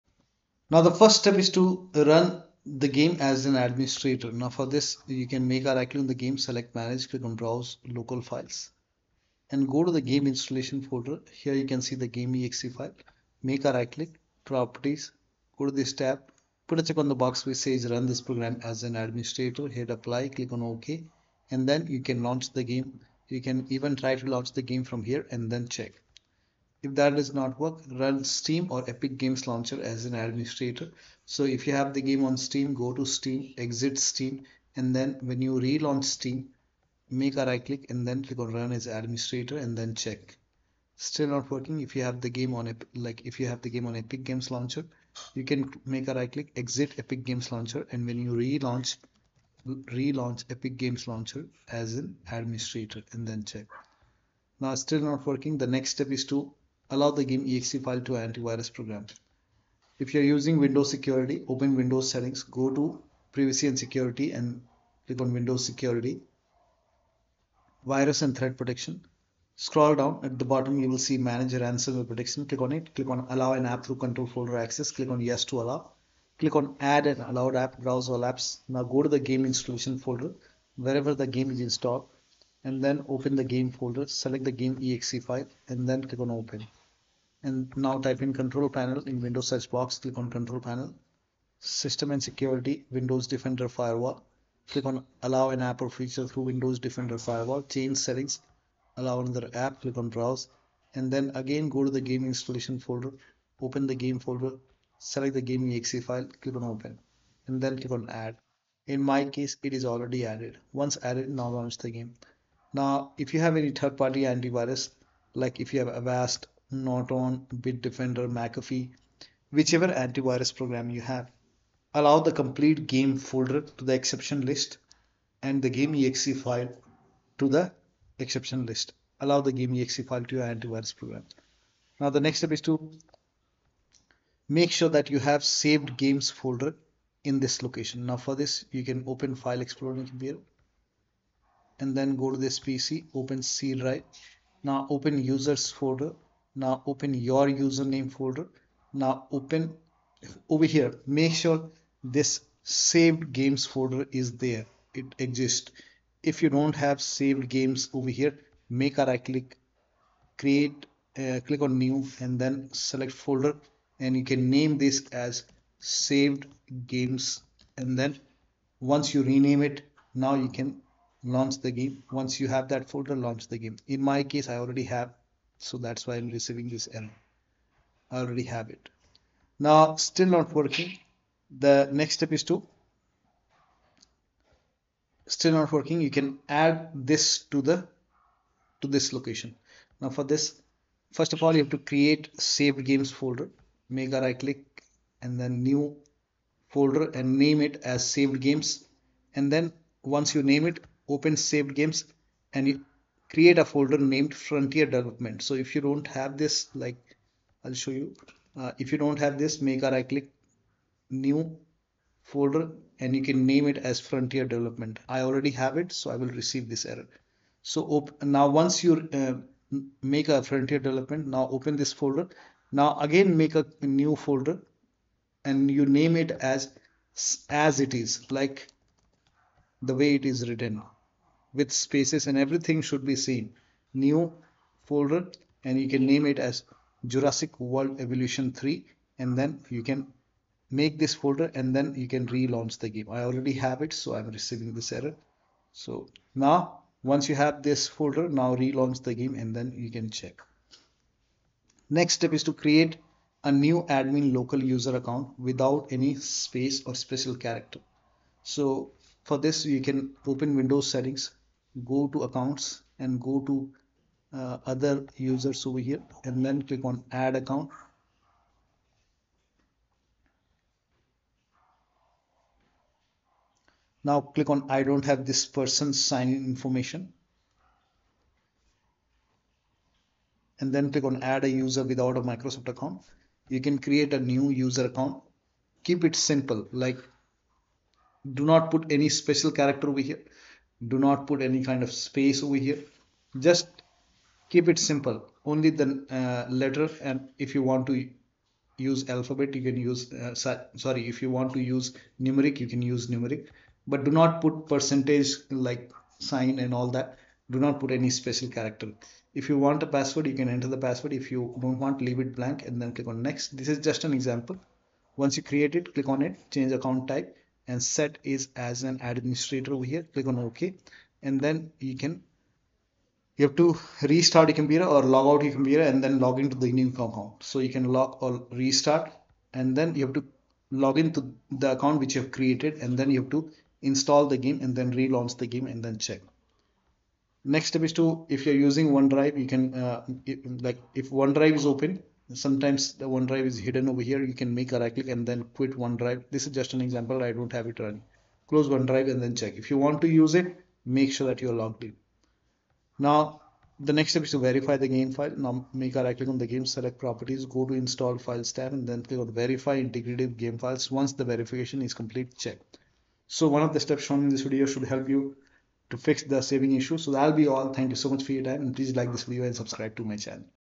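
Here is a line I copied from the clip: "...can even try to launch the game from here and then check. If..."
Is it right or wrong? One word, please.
right.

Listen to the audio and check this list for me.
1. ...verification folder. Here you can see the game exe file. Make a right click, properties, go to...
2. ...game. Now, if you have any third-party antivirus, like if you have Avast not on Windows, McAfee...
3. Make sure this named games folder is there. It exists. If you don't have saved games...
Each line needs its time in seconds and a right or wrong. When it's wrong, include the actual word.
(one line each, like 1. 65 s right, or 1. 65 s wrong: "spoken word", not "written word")
1. 10 s wrong: "installation", not "verification"
2. 111 s wrong: "Bitdefender", not "Windows"
3. 151 s wrong: "saved", not "named".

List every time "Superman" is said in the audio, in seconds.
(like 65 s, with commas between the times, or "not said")
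not said.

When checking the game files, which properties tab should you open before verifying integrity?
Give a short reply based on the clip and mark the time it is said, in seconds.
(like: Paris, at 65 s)
Install files, at 357 s.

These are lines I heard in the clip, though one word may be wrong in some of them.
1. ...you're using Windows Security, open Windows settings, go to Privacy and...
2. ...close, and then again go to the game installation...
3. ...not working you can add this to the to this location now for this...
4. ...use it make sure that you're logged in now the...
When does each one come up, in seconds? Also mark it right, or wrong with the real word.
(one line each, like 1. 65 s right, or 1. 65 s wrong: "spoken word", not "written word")
1. 60 s right
2. 100 s wrong: "browse", not "close"
3. 185 s right
4. 350 s right.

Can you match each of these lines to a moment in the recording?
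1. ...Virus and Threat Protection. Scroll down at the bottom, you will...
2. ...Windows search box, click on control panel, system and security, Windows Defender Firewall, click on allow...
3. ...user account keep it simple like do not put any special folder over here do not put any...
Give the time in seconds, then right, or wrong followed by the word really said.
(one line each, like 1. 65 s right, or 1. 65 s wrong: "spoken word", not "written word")
1. 67 s right
2. 89 s right
3. 284 s wrong: "character", not "folder".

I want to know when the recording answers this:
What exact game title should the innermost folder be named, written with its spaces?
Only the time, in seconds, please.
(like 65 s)
237 s.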